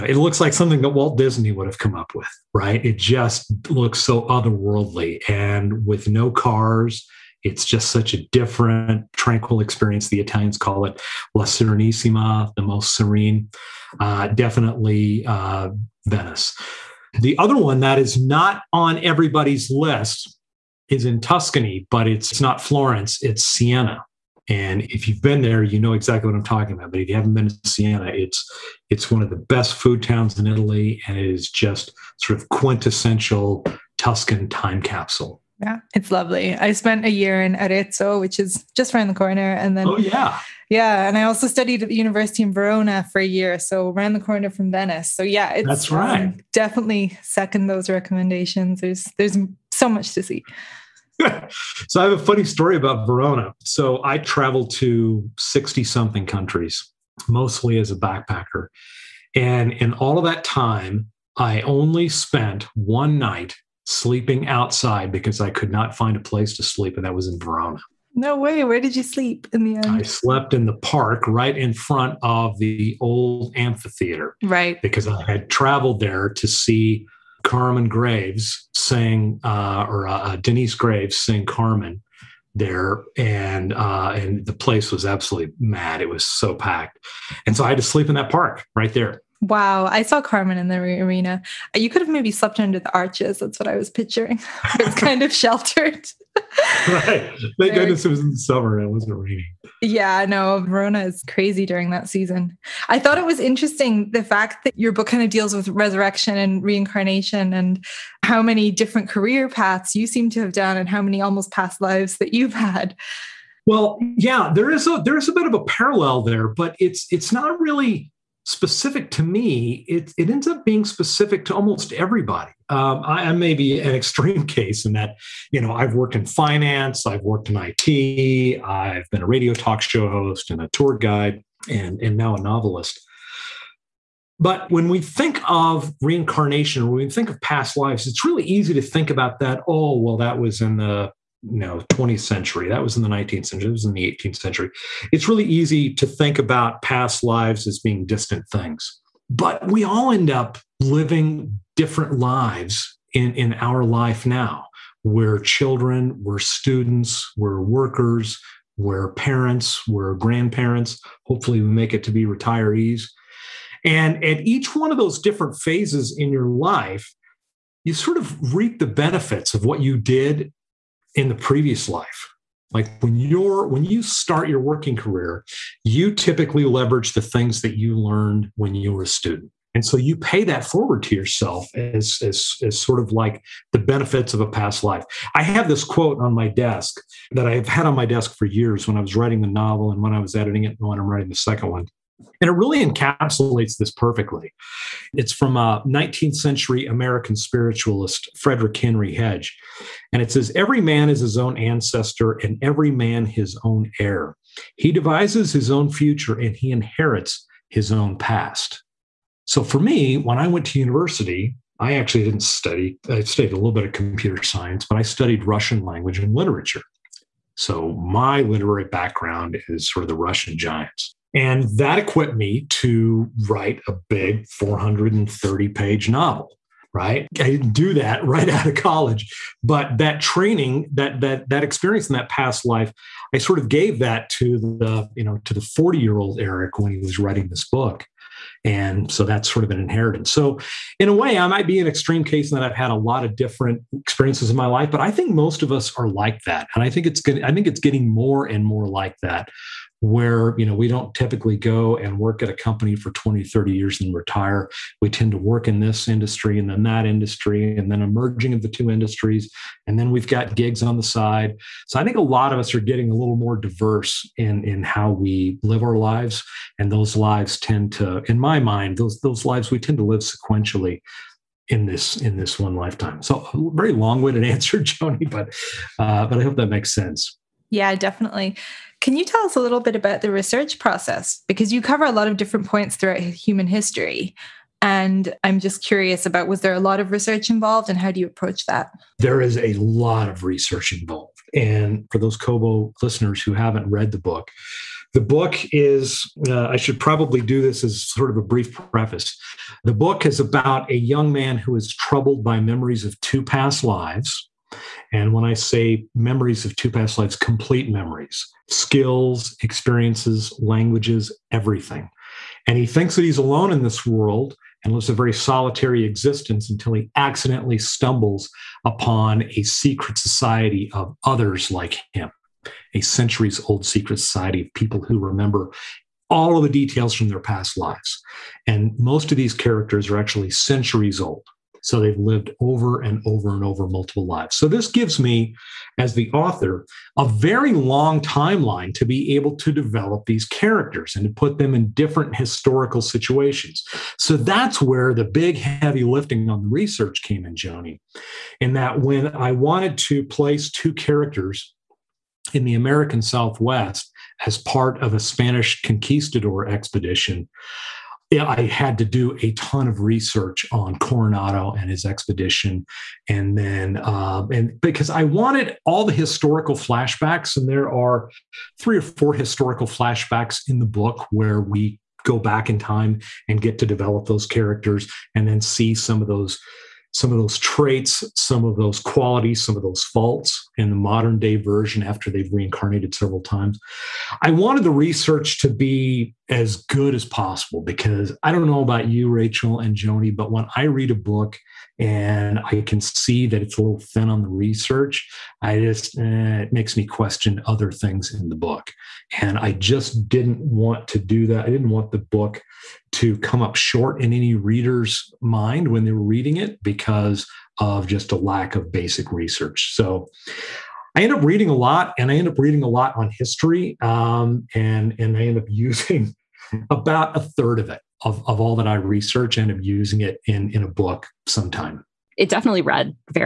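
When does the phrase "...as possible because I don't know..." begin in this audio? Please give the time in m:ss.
6:27.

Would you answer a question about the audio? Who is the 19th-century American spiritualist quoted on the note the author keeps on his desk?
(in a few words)
Frederick Henry Hedge.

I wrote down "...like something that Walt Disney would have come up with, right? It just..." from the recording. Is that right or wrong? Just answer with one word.
right.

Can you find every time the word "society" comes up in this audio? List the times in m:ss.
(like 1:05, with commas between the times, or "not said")
5:20, 5:24.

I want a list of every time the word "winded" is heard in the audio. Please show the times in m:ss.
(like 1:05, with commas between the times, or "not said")
4:33.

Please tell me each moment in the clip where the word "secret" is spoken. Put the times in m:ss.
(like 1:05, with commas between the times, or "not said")
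5:19, 5:23.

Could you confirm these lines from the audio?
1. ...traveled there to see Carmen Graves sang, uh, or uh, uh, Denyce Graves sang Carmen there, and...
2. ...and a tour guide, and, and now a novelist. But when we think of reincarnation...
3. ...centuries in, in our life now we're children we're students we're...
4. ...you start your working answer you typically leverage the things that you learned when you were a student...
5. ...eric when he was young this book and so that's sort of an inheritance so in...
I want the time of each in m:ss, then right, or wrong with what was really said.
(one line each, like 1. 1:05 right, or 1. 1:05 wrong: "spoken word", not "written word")
1. 1:15 right
2. 2:10 right
3. 2:32 wrong: "lives", not "centuries"
4. 2:53 wrong: "career", not "answer"
5. 3:56 wrong: "writing", not "young".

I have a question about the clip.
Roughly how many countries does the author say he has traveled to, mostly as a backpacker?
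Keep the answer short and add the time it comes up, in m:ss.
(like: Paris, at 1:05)
60 something, at 0:55.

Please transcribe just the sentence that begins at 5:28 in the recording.
And most of these characters are actually centuries old.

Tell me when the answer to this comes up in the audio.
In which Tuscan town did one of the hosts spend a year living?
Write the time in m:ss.
0:37.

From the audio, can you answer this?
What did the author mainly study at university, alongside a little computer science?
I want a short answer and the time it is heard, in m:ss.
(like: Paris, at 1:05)
Russian language and literature, at 3:35.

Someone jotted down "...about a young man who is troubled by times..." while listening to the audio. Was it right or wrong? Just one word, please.
wrong.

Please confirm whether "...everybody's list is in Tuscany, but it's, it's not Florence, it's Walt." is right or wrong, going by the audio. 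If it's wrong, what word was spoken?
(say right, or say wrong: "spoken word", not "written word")
wrong: "Siena", not "Walt".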